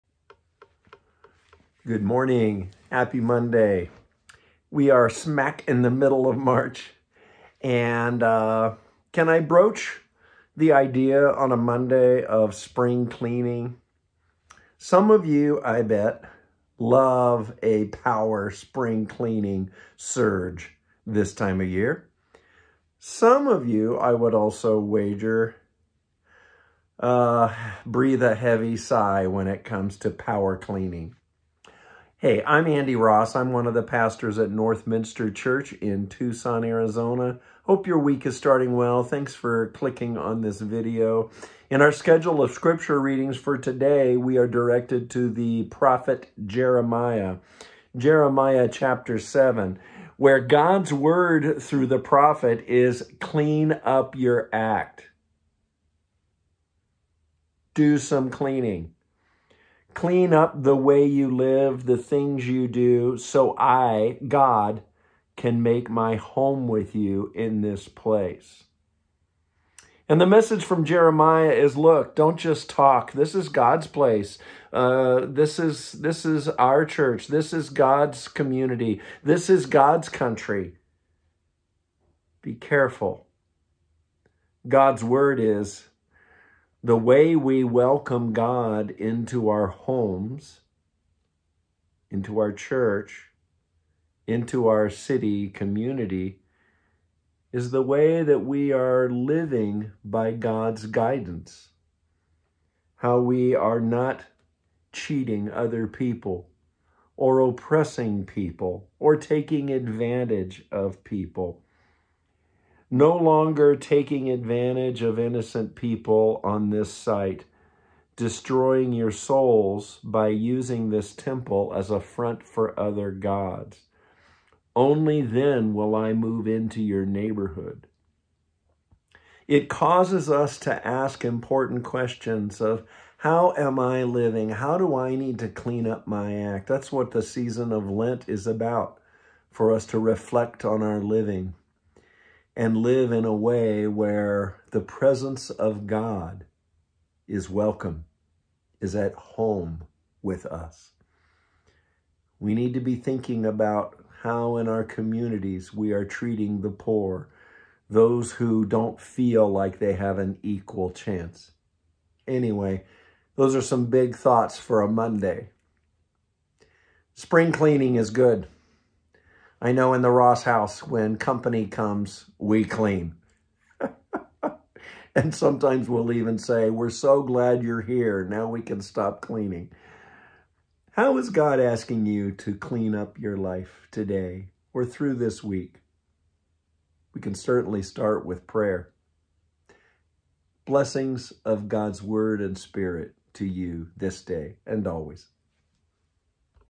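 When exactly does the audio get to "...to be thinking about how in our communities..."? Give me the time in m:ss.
2:32.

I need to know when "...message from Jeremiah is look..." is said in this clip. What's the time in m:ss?
1:10.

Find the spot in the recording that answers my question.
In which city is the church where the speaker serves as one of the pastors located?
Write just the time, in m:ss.
0:36.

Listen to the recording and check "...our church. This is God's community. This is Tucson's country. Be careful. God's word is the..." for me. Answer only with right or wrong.
wrong.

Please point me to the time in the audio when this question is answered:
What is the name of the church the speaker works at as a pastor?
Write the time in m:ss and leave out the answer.
0:34.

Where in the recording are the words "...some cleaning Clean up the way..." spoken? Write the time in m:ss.
0:57.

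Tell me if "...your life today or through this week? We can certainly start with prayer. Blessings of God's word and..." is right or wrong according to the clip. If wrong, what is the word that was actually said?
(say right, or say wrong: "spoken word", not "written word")
right.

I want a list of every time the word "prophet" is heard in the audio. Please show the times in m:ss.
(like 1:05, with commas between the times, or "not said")
0:45, 0:51.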